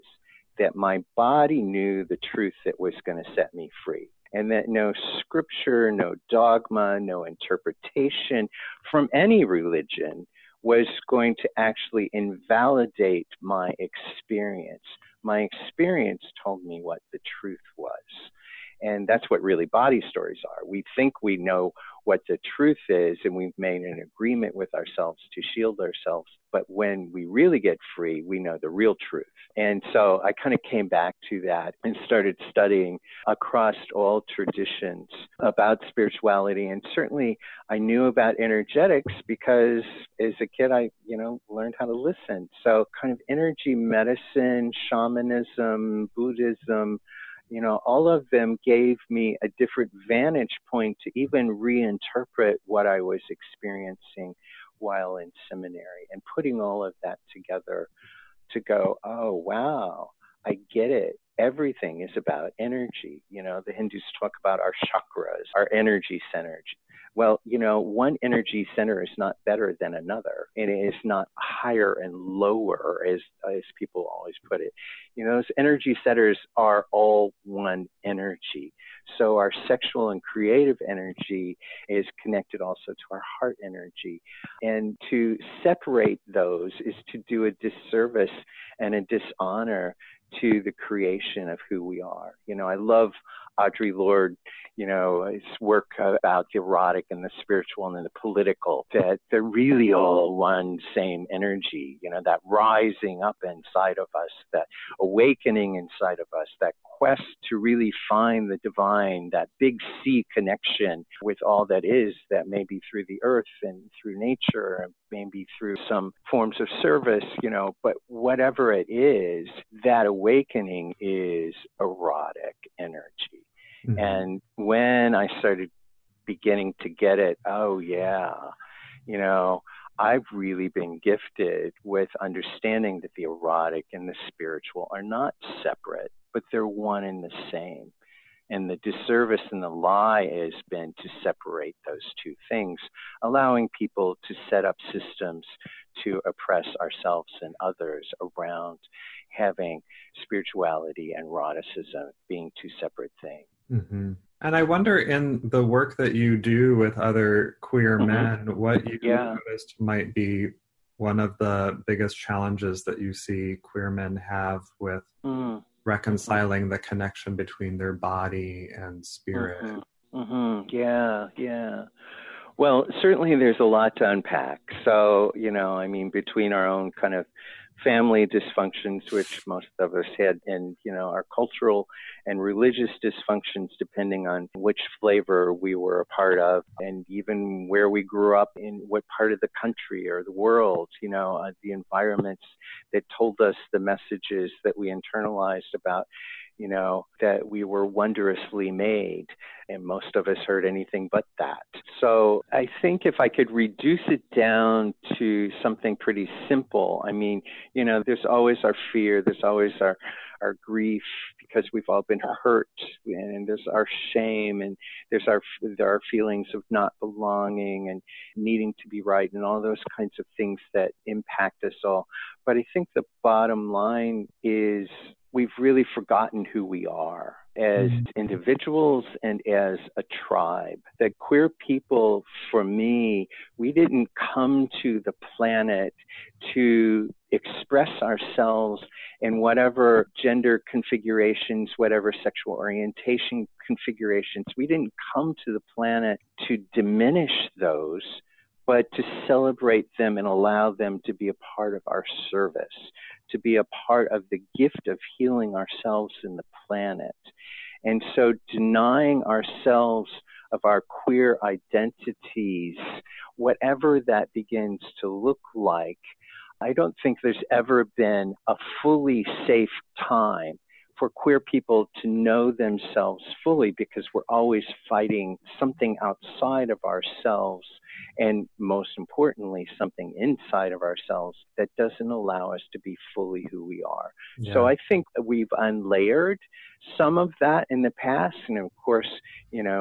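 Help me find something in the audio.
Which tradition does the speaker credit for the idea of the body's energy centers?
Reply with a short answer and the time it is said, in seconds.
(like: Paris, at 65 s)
Hindus, at 63 s.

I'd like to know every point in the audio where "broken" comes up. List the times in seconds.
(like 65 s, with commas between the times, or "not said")
not said.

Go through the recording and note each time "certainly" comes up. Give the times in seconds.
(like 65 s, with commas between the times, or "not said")
36 s, 173 s.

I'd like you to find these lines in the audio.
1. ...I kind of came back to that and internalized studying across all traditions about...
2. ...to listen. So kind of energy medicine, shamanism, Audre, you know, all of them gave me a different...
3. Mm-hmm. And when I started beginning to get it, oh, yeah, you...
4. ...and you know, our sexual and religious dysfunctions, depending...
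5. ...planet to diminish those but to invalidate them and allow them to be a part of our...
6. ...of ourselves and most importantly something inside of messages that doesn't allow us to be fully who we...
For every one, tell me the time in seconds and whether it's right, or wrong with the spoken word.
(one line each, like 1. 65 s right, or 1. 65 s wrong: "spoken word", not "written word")
1. 30 s wrong: "started", not "internalized"
2. 41 s wrong: "Buddhism", not "Audre"
3. 123 s right
4. 180 s wrong: "cultural", not "sexual"
5. 245 s wrong: "celebrate", not "invalidate"
6. 276 s wrong: "ourselves", not "messages".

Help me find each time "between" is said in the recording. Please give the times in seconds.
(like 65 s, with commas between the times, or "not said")
167 s, 176 s.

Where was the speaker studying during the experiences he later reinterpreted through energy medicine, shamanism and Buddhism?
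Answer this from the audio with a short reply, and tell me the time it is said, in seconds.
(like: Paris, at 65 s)
Seminary, at 55 s.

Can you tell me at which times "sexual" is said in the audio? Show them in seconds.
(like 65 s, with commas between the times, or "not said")
79 s, 242 s.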